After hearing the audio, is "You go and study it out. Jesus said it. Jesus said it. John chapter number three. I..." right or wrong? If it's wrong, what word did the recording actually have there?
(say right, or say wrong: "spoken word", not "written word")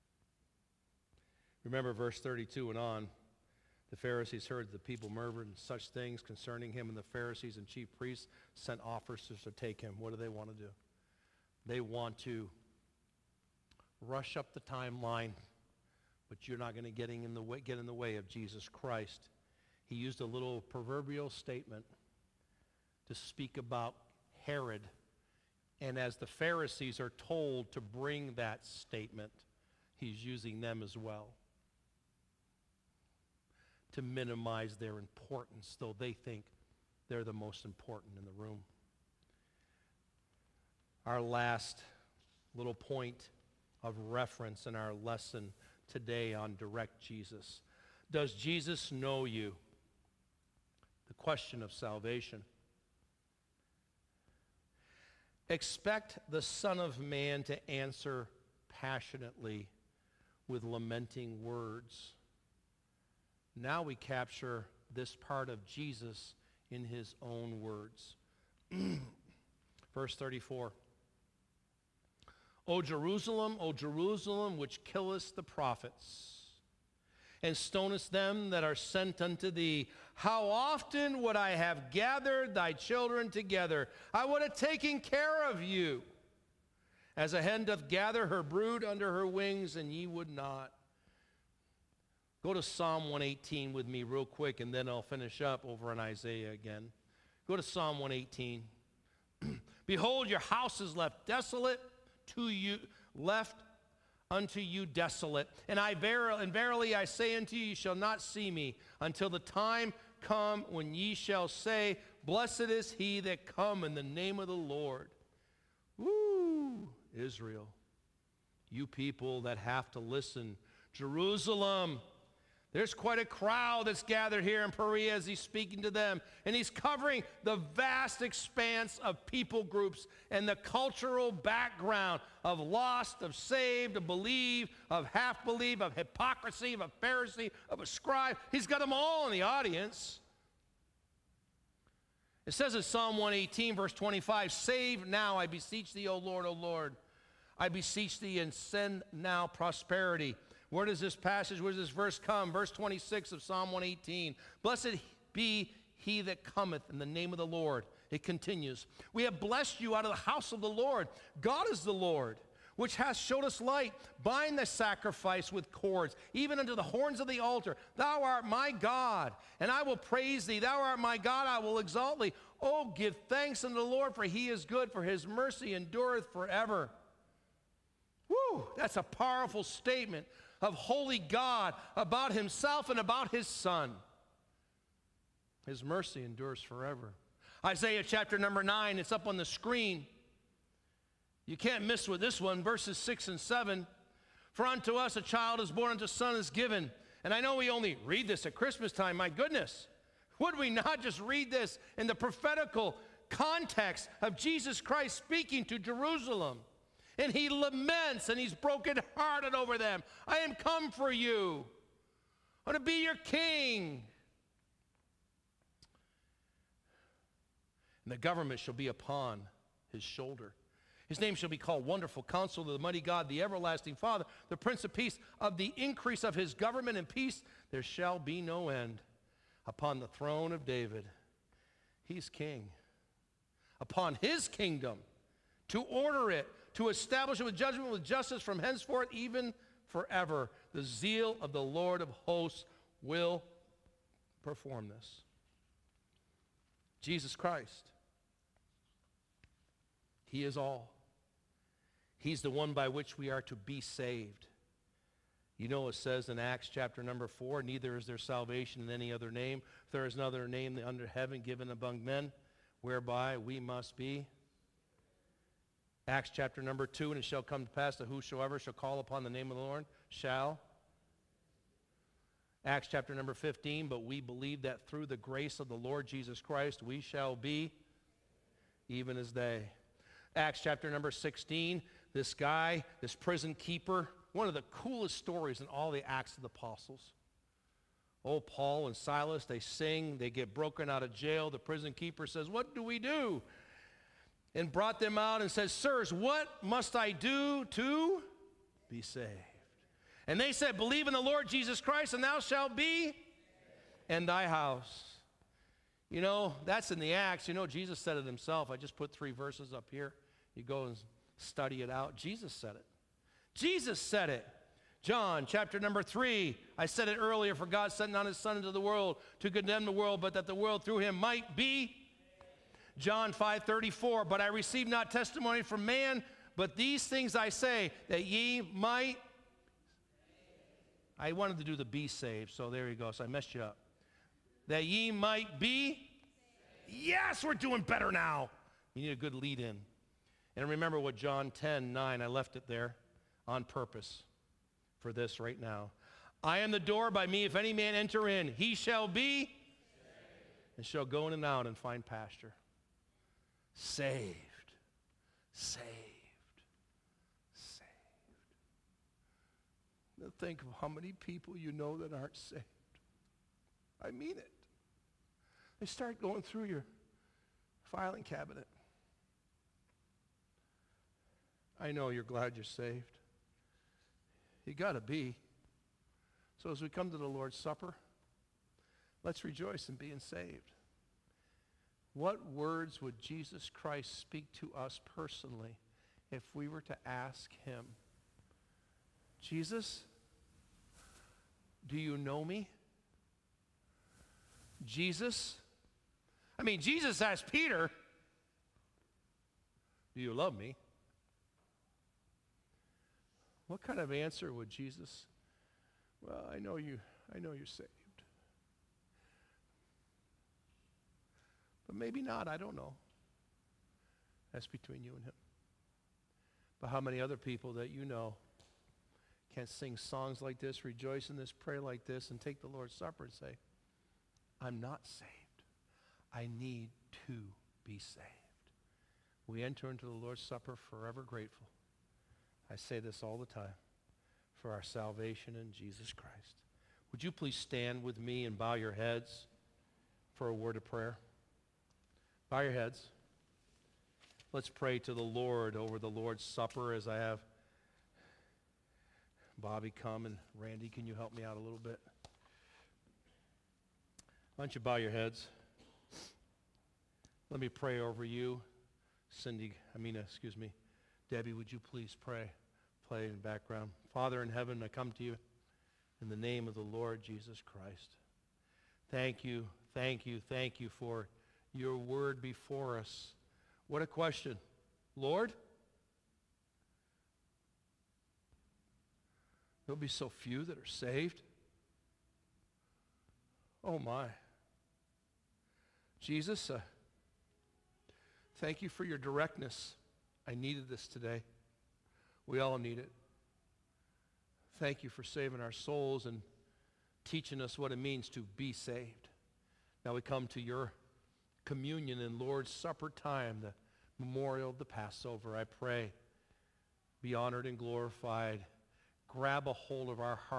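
right.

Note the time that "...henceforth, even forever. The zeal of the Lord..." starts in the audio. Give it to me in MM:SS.
03:58.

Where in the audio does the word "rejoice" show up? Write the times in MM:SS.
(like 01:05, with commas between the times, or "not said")
06:19, 07:00.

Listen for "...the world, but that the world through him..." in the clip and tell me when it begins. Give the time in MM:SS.
05:19.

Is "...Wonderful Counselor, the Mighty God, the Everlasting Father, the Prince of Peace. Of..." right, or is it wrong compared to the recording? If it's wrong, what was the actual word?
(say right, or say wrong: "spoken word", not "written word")
right.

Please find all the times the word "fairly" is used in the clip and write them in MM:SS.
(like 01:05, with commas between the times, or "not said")
not said.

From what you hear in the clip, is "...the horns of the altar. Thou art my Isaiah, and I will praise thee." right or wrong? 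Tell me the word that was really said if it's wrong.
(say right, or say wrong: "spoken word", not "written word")
wrong: "God", not "Isaiah".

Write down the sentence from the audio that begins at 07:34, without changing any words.
Why don't you bow your heads?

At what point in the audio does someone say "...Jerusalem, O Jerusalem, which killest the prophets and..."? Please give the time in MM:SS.
01:12.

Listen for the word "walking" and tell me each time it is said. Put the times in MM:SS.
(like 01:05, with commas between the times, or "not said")
not said.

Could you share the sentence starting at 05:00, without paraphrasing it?
And they said, Believe in the Lord Jesus Christ, and thou shalt be and thy house.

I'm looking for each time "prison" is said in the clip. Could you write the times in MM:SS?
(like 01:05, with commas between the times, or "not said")
04:43, 04:51.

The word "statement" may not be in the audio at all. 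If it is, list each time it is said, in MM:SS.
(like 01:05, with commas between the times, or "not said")
00:21, 00:28, 02:59.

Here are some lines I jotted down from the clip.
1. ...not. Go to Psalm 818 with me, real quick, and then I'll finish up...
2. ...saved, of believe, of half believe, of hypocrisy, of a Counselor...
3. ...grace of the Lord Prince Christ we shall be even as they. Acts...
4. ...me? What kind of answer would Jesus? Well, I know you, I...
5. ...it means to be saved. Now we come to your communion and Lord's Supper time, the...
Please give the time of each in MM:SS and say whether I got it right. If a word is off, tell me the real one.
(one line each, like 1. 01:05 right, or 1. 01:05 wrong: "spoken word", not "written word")
1. 01:30 wrong: "118", not "818"
2. 02:13 wrong: "Pharisee", not "Counselor"
3. 04:35 wrong: "Jesus", not "Prince"
4. 06:40 right
5. 08:17 right.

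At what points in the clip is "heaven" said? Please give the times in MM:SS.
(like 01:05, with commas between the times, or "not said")
04:21, 07:44.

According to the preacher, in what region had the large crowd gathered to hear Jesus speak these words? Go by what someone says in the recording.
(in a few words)
Perea.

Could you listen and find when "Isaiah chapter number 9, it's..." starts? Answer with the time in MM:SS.
03:07.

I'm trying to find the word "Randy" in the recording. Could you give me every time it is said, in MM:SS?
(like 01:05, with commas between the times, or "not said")
07:30.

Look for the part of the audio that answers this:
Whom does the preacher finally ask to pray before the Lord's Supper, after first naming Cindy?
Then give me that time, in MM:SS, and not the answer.
07:41.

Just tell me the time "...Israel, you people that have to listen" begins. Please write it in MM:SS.
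01:57.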